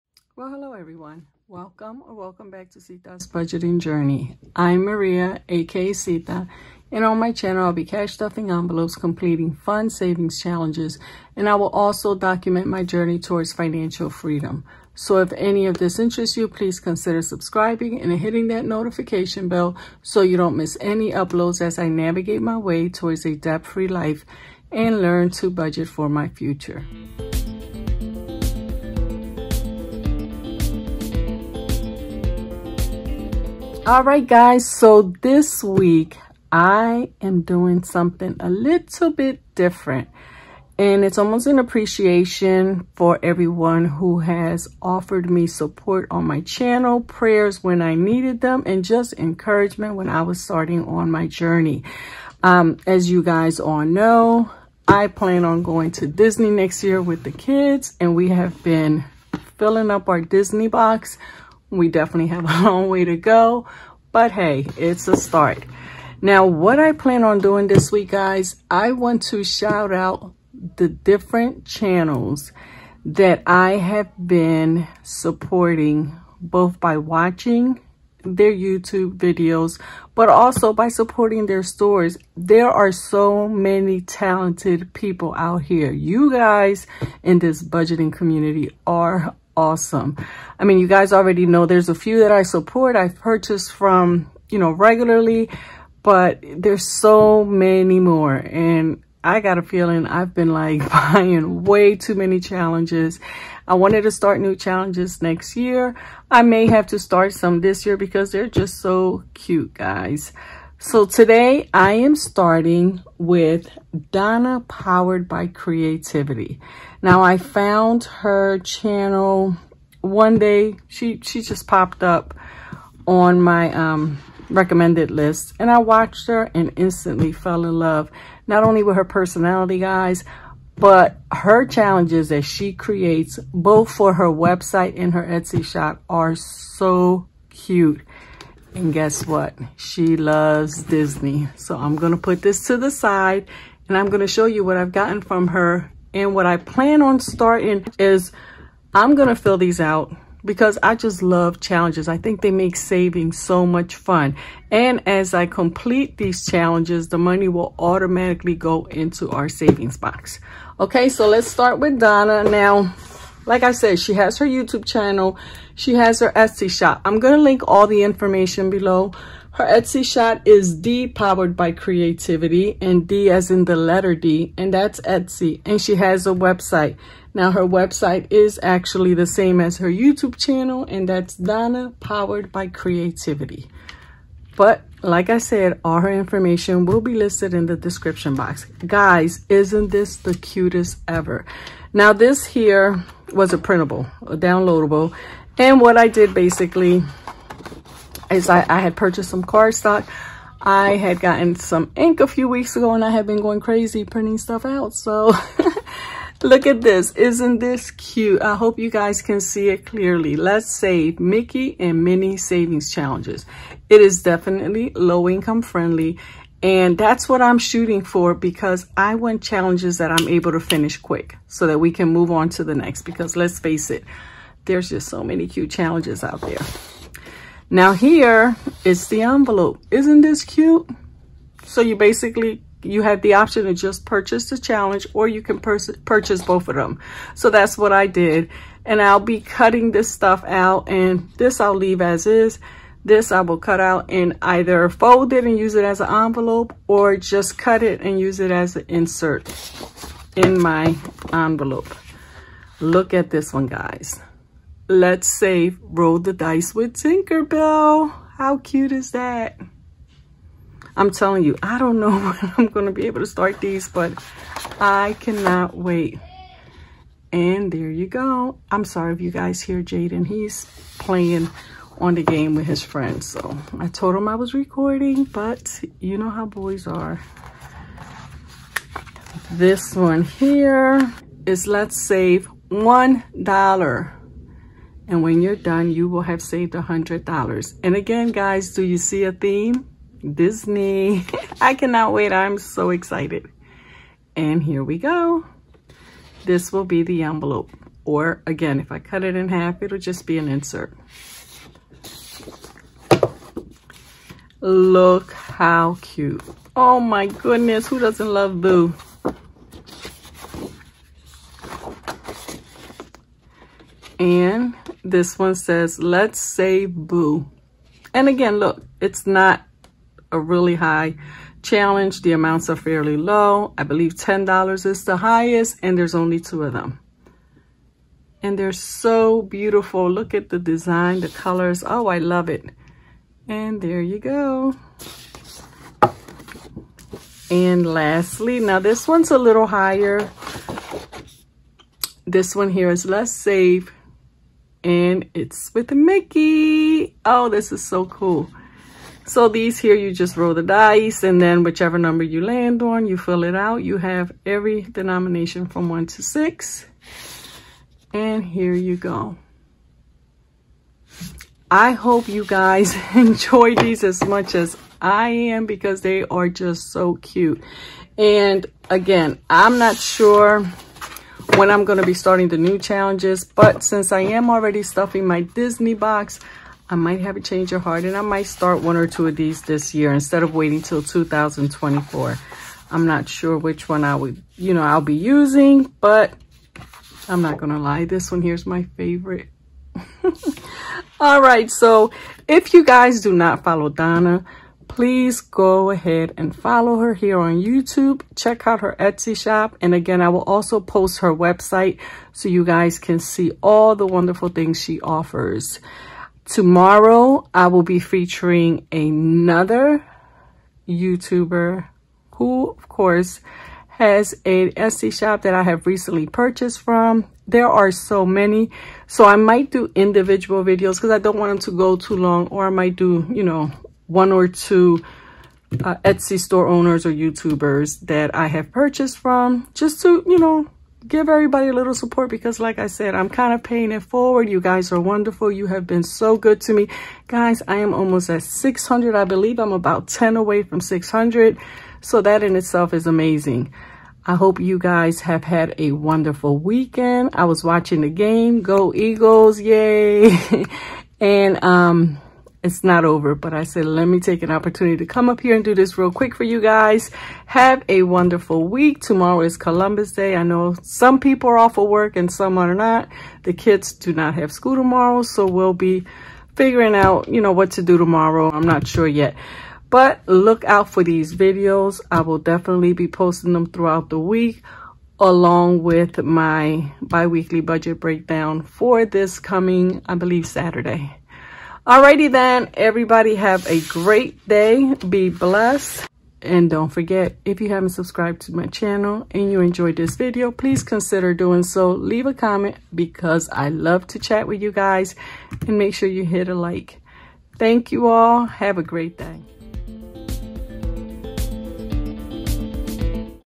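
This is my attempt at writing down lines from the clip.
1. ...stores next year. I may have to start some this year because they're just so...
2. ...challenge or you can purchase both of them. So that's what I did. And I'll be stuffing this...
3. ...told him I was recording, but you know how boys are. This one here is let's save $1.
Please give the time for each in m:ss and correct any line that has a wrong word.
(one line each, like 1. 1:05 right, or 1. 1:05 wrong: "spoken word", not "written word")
1. 1:44 wrong: "challenges", not "stores"
2. 3:54 wrong: "cutting", not "stuffing"
3. 4:33 right.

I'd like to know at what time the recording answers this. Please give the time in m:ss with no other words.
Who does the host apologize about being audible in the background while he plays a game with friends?
4:29.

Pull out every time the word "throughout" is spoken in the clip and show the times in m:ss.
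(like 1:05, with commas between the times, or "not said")
7:53.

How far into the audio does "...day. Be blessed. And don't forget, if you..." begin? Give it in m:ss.
8:04.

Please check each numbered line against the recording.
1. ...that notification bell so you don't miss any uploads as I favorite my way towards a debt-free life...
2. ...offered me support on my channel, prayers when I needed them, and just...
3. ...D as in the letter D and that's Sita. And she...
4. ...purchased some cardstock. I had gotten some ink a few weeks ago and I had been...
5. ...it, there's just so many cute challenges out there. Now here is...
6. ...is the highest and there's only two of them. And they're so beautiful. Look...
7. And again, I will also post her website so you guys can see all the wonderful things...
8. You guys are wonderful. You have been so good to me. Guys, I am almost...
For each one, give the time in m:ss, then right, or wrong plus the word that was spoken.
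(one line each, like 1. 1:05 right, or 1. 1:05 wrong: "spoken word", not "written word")
1. 0:18 wrong: "navigate", not "favorite"
2. 0:44 right
3. 2:53 wrong: "Etsy", not "Sita"
4. 3:18 right
5. 3:43 right
6. 5:24 right
7. 6:39 right
8. 7:14 right.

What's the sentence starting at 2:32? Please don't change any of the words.
I think they make saving so much fun.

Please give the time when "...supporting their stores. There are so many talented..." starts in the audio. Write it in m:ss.
1:20.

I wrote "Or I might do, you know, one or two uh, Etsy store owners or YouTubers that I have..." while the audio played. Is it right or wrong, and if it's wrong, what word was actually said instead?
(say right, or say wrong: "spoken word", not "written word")
right.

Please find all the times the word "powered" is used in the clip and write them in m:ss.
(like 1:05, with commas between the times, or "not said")
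1:54, 2:51, 3:01.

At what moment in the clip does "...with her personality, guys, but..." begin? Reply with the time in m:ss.
2:08.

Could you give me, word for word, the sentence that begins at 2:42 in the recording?
Now, like I said, she has her YouTube channel.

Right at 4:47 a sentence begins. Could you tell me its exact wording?
And again, guys, do you see a theme?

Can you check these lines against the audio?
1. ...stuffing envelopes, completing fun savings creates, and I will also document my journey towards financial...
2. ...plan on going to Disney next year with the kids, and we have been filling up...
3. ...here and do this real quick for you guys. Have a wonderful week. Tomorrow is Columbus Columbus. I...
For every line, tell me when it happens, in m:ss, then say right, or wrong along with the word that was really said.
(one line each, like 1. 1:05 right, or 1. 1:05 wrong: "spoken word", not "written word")
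1. 0:08 wrong: "challenges", not "creates"
2. 0:55 right
3. 7:35 wrong: "Day", not "Columbus".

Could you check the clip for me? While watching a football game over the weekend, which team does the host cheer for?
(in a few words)
Eagles.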